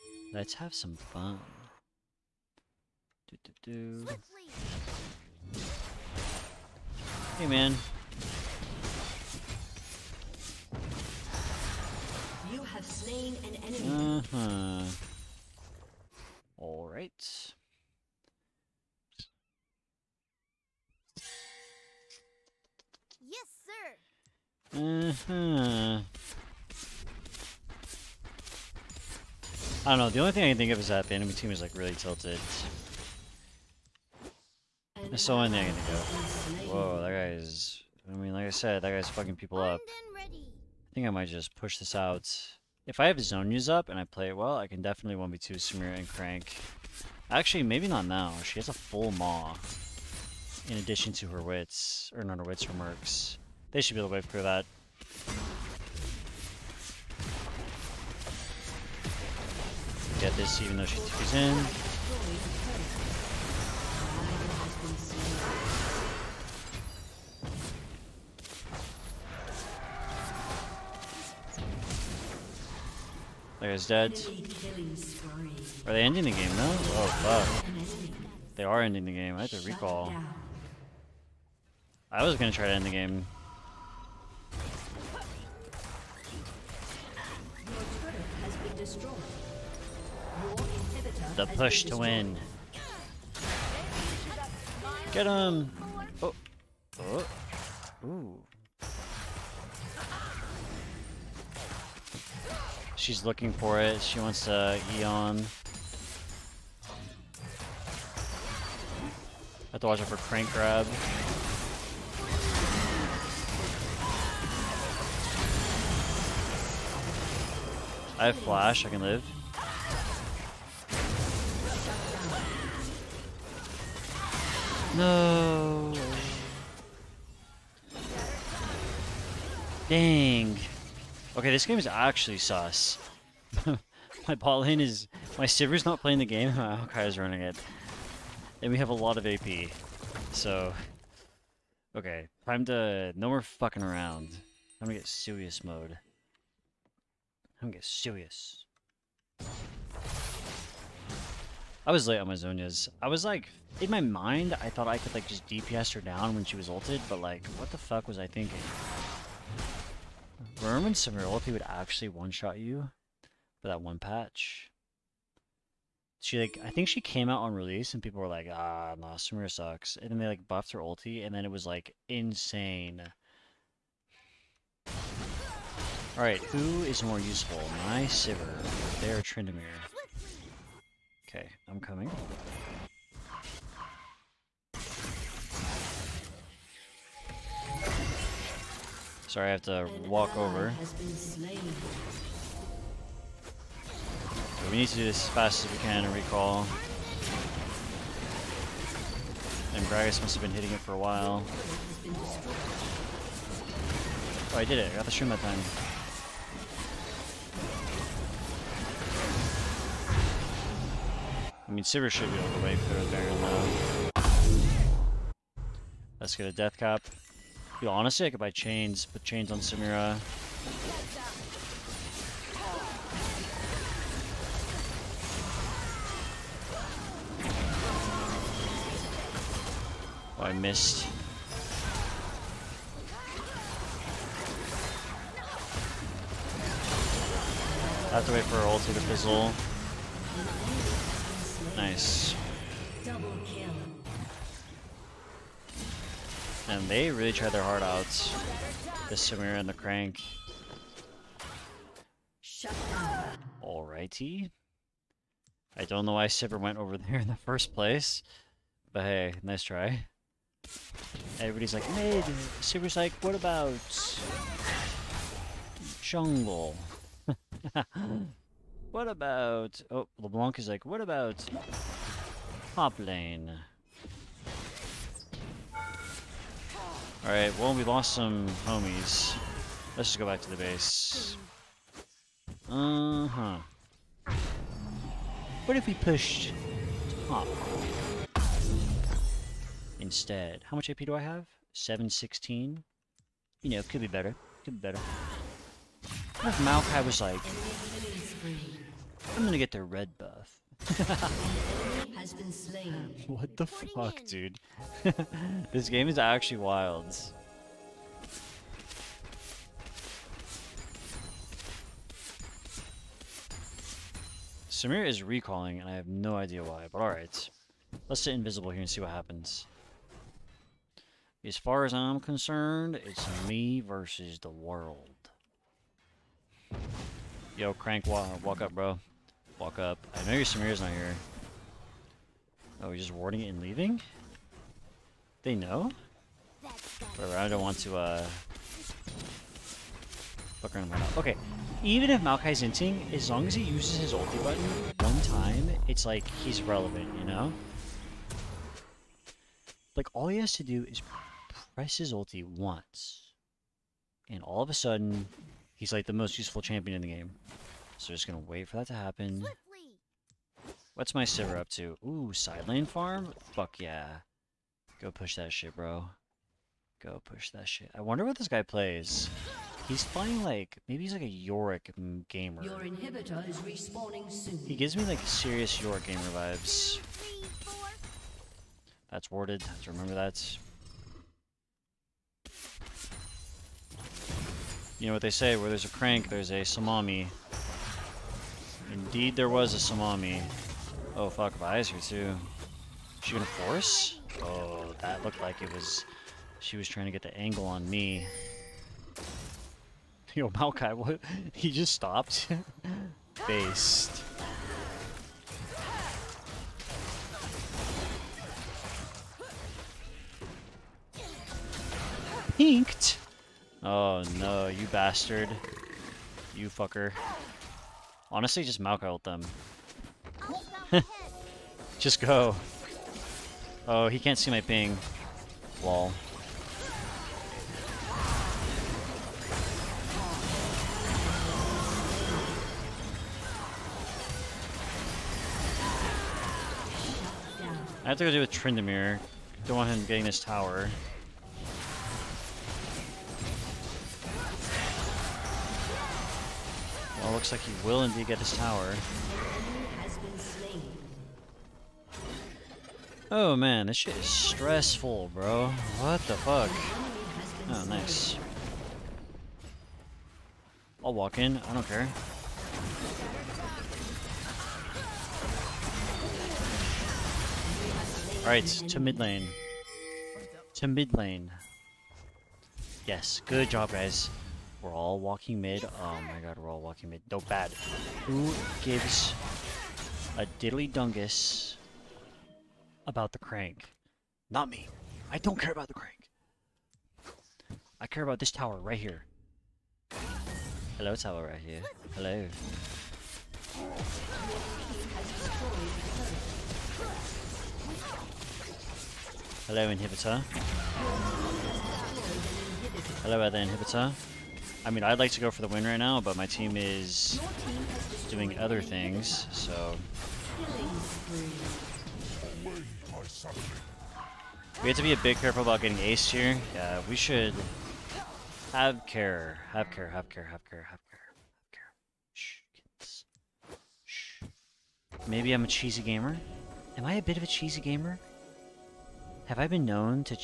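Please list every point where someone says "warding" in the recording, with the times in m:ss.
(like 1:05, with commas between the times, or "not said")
5:33.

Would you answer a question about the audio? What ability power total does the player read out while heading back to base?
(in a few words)
716.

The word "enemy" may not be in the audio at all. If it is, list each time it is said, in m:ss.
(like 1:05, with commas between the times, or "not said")
0:13, 0:31.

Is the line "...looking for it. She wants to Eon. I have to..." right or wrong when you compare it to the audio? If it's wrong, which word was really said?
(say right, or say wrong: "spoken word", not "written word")
right.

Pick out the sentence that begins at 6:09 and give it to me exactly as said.
He's playing like, maybe he's like a Yorick gamer.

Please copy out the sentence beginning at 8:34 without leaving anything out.
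We have to be a bit careful about getting aced here.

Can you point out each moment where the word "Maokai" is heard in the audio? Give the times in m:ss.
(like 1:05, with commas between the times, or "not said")
4:56, 5:42, 6:40.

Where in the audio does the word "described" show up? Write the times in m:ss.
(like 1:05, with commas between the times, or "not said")
not said.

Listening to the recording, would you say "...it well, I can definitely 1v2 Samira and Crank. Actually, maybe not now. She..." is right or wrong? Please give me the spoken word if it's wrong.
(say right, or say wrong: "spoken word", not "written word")
right.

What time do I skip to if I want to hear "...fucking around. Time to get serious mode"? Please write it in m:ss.
2:23.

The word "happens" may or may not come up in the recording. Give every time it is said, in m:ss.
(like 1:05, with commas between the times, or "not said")
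5:19, 5:58.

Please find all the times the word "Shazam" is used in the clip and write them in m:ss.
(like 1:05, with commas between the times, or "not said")
not said.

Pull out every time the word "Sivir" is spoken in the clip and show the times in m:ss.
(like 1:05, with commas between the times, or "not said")
2:15, 2:58, 3:31, 4:16, 4:22, 6:01.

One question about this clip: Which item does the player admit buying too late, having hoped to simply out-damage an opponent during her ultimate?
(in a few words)
Zhonya's.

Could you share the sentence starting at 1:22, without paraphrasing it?
I was gonna try to end the game.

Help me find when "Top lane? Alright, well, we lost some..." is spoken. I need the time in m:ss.
4:32.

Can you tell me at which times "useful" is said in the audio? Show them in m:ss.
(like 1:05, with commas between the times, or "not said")
2:57, 5:56.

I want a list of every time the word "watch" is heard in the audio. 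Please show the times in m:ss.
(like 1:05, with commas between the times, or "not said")
1:49.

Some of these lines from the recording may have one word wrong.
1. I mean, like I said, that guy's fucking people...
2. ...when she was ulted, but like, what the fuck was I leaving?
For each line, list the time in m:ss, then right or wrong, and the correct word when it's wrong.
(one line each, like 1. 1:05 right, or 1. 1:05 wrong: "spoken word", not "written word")
1. 0:38 right
2. 2:36 wrong: "thinking", not "leaving".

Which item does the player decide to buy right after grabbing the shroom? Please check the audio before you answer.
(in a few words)
Deathcap.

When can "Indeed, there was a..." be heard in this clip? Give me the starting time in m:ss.
6:28.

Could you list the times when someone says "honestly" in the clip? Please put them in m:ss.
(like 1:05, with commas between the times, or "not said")
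3:37, 6:58.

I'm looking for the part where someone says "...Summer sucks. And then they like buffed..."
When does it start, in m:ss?
2:49.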